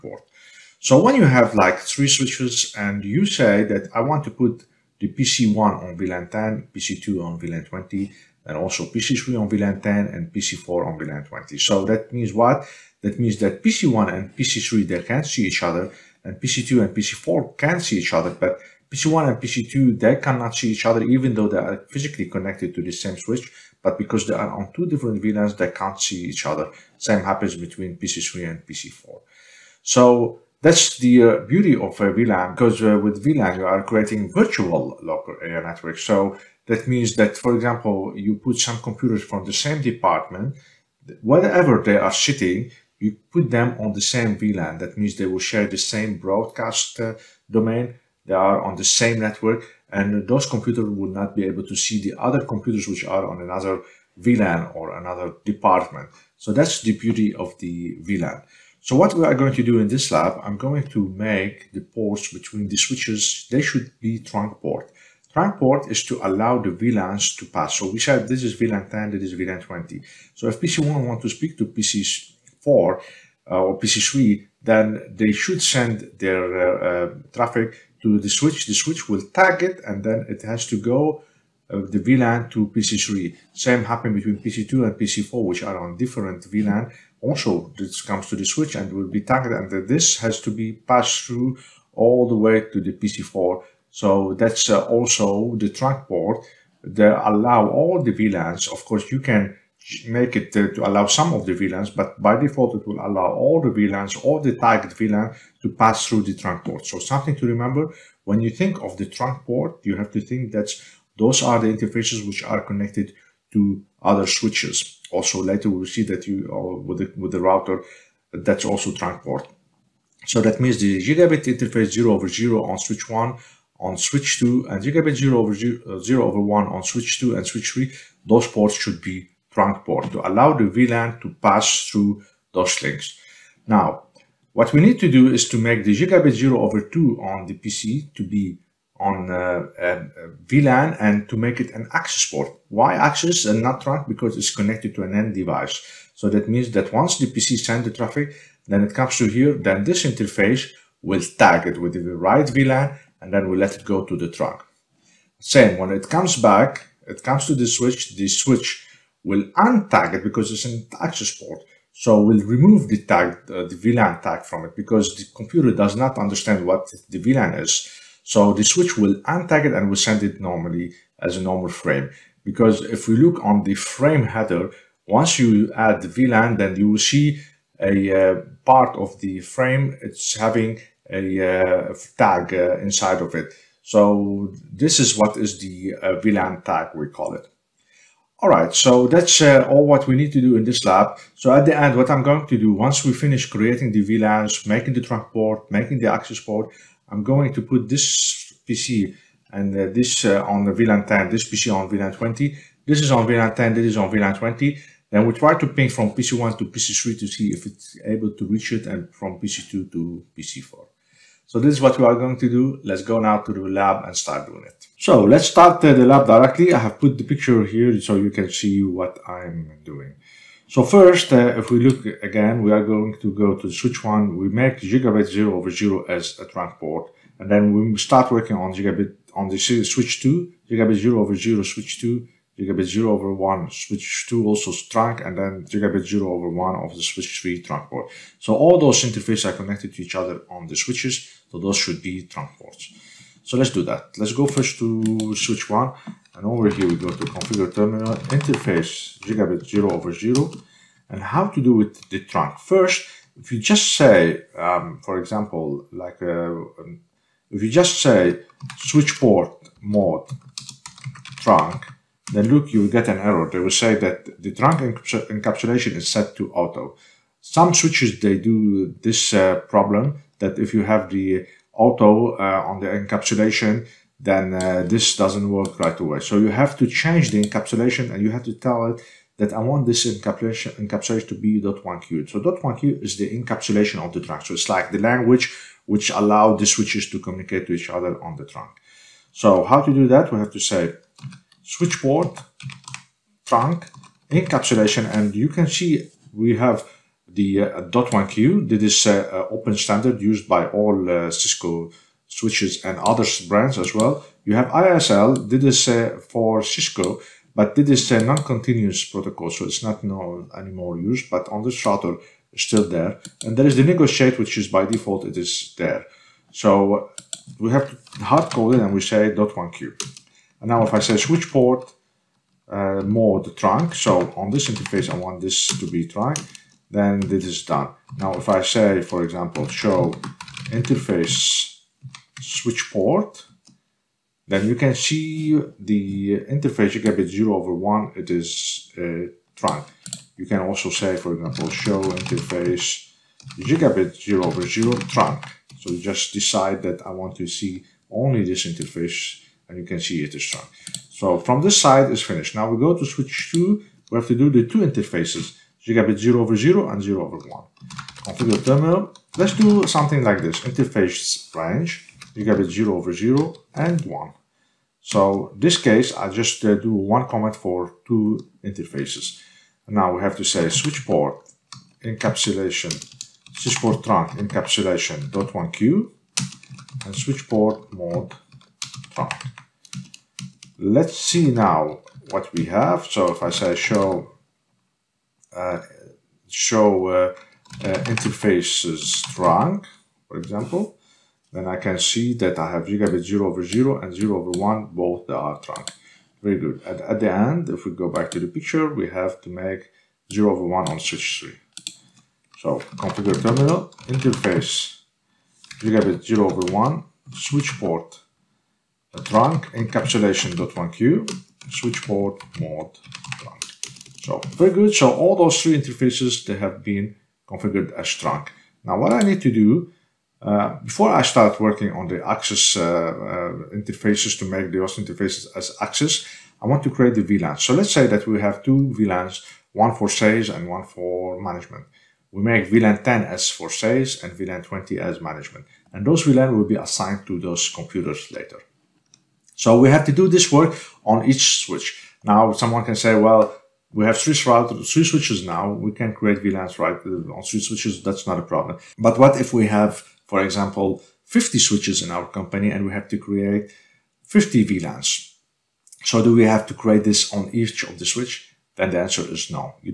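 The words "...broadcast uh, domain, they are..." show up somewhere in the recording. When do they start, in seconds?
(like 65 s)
46 s.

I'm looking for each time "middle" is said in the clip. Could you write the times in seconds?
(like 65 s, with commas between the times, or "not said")
not said.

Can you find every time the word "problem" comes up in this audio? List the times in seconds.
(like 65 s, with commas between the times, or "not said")
269 s, 448 s.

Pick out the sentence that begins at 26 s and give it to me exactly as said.
Same happens between PC3 and PC4.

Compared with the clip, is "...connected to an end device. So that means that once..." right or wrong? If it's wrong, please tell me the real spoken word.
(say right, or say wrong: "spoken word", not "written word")
right.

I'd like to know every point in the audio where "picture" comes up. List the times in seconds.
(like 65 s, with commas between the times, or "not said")
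217 s, 398 s.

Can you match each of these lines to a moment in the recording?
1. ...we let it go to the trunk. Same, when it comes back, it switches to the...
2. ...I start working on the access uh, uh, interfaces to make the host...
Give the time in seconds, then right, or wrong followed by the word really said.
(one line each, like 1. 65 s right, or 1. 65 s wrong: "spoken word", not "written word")
1. 153 s wrong: "comes", not "switches"
2. 421 s right.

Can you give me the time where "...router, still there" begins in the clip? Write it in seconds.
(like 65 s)
311 s.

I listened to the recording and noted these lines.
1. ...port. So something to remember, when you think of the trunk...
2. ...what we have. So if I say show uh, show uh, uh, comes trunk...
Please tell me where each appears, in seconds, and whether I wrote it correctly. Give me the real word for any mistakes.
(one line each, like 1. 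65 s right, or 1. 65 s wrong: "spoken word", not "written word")
1. 106 s right
2. 382 s wrong: "interfaces", not "comes".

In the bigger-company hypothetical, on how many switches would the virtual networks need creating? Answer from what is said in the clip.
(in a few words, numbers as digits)
50.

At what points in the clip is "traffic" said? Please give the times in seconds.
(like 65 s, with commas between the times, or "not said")
77 s, 147 s.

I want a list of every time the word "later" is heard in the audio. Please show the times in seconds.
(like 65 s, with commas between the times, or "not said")
115 s, 438 s.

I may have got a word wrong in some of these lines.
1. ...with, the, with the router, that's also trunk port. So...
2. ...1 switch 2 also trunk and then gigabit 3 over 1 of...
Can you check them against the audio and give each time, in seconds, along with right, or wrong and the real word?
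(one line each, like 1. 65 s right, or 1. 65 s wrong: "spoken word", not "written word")
1. 116 s right
2. 233 s wrong: "0", not "3".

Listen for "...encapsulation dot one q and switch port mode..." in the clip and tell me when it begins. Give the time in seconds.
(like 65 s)
374 s.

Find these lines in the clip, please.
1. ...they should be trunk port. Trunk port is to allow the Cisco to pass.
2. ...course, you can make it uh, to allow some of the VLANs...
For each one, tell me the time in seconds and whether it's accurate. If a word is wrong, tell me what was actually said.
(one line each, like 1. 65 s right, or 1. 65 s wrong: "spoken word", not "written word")
1. 63 s wrong: "VLANs", not "Cisco"
2. 98 s right.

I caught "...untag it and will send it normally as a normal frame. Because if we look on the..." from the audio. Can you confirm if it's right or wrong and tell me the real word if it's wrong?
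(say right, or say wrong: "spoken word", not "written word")
right.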